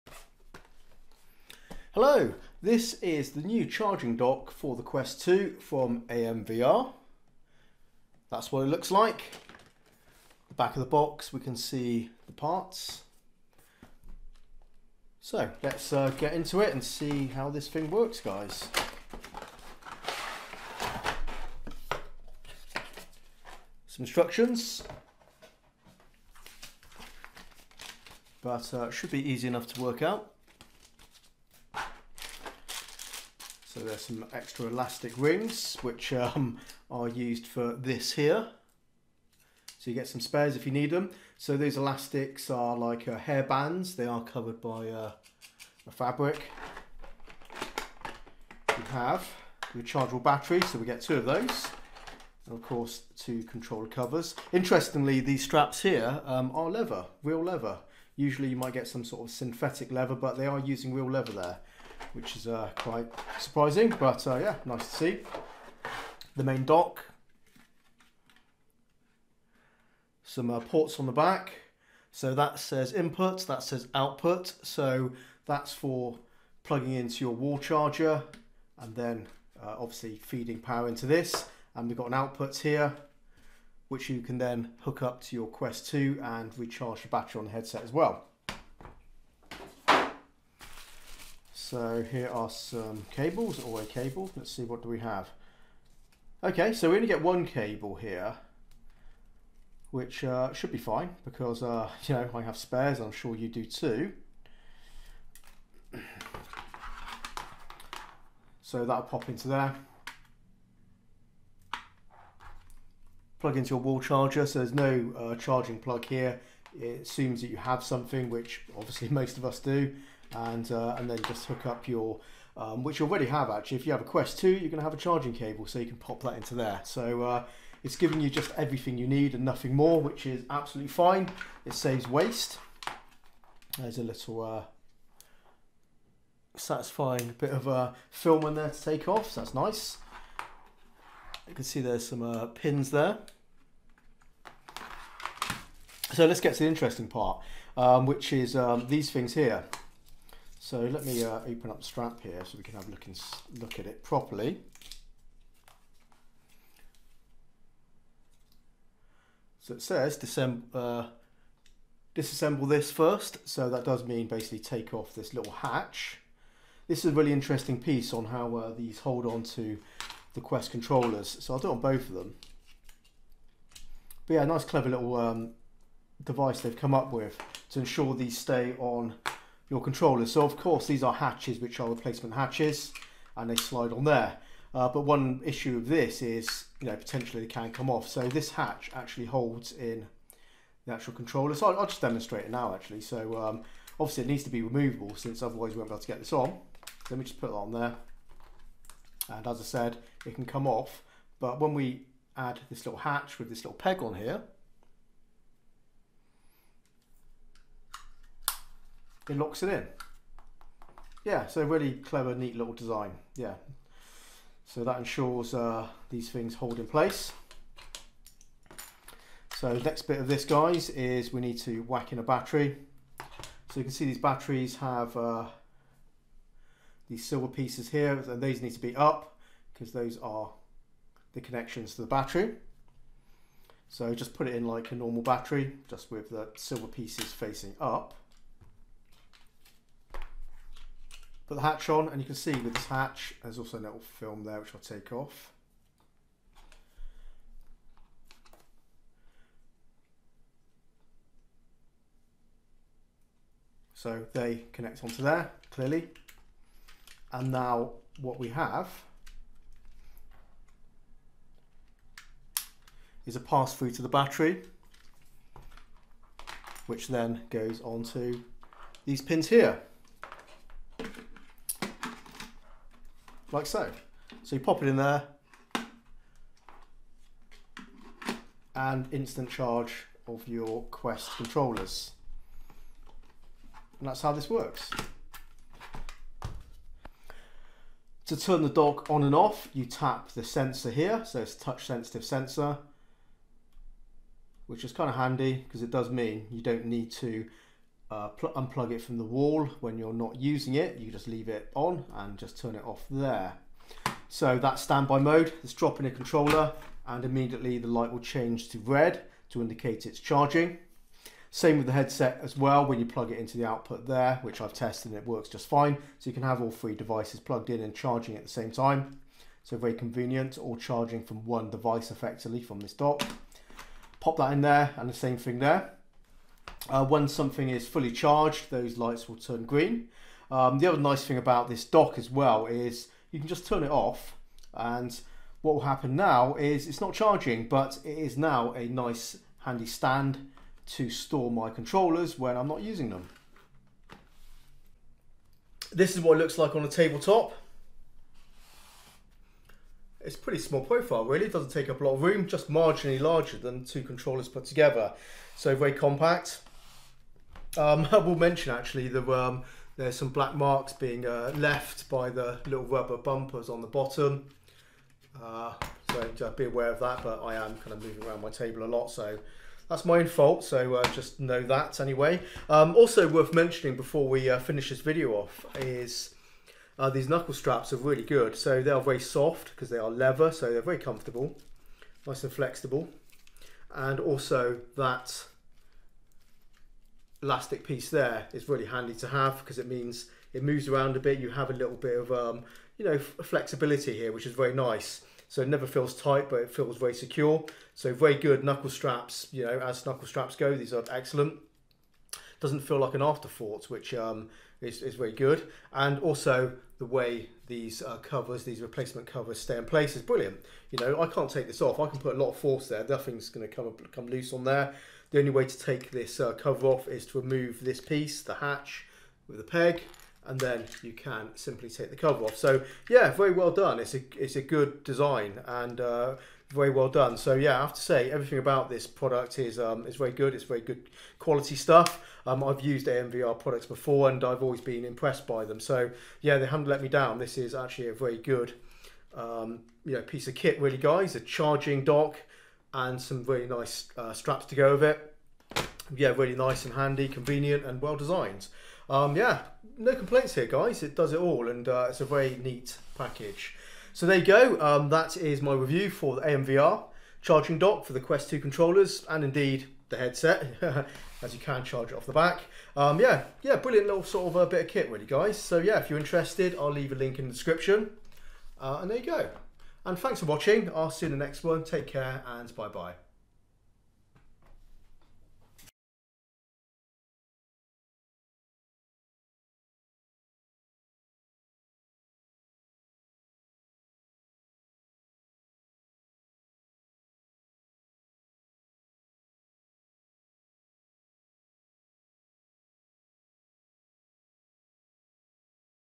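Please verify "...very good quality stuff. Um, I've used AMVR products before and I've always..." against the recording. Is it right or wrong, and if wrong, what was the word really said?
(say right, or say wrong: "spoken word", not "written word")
right.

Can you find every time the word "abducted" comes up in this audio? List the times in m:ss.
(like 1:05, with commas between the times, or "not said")
not said.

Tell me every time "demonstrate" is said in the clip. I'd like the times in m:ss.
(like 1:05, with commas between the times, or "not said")
3:12.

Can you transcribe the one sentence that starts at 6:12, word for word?
Um, also worth mentioning before we uh, finish this video off is uh, these knuckle straps are really good.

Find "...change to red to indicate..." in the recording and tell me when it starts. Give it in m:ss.
5:08.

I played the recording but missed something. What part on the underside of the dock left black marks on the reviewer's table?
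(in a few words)
Rubber bumpers.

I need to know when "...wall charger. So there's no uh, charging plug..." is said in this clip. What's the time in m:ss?
1:53.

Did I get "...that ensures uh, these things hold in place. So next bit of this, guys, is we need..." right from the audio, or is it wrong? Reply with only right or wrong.
right.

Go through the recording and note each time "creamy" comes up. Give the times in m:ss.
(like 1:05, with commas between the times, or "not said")
not said.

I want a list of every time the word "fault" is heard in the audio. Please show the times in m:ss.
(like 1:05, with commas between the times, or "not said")
6:10.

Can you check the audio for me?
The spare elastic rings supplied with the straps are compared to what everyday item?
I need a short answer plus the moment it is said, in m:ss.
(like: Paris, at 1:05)
Hair bands, at 0:43.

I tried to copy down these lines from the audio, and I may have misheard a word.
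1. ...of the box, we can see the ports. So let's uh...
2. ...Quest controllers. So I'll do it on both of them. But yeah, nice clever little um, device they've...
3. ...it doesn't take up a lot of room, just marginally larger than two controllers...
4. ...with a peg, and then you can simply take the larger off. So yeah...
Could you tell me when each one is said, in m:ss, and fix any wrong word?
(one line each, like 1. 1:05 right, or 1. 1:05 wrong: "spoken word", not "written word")
1. 0:10 wrong: "parts", not "ports"
2. 2:50 right
3. 5:51 right
4. 6:59 wrong: "cover", not "larger".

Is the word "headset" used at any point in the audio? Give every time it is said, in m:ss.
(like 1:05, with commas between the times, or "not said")
1:27, 5:11, 7:40.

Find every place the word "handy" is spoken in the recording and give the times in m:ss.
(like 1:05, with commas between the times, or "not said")
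4:55, 5:39, 6:28, 7:26.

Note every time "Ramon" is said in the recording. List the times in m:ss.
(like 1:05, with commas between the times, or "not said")
not said.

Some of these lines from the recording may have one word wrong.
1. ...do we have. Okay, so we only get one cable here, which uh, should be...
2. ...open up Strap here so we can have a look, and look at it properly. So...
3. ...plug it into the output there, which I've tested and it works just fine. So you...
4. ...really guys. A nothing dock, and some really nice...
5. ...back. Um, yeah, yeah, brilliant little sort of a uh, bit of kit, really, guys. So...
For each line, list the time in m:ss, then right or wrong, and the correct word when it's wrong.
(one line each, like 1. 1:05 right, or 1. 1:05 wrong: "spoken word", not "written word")
1. 1:34 right
2. 2:31 right
3. 5:13 right
4. 7:20 wrong: "charging", not "nothing"
5. 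7:42 right.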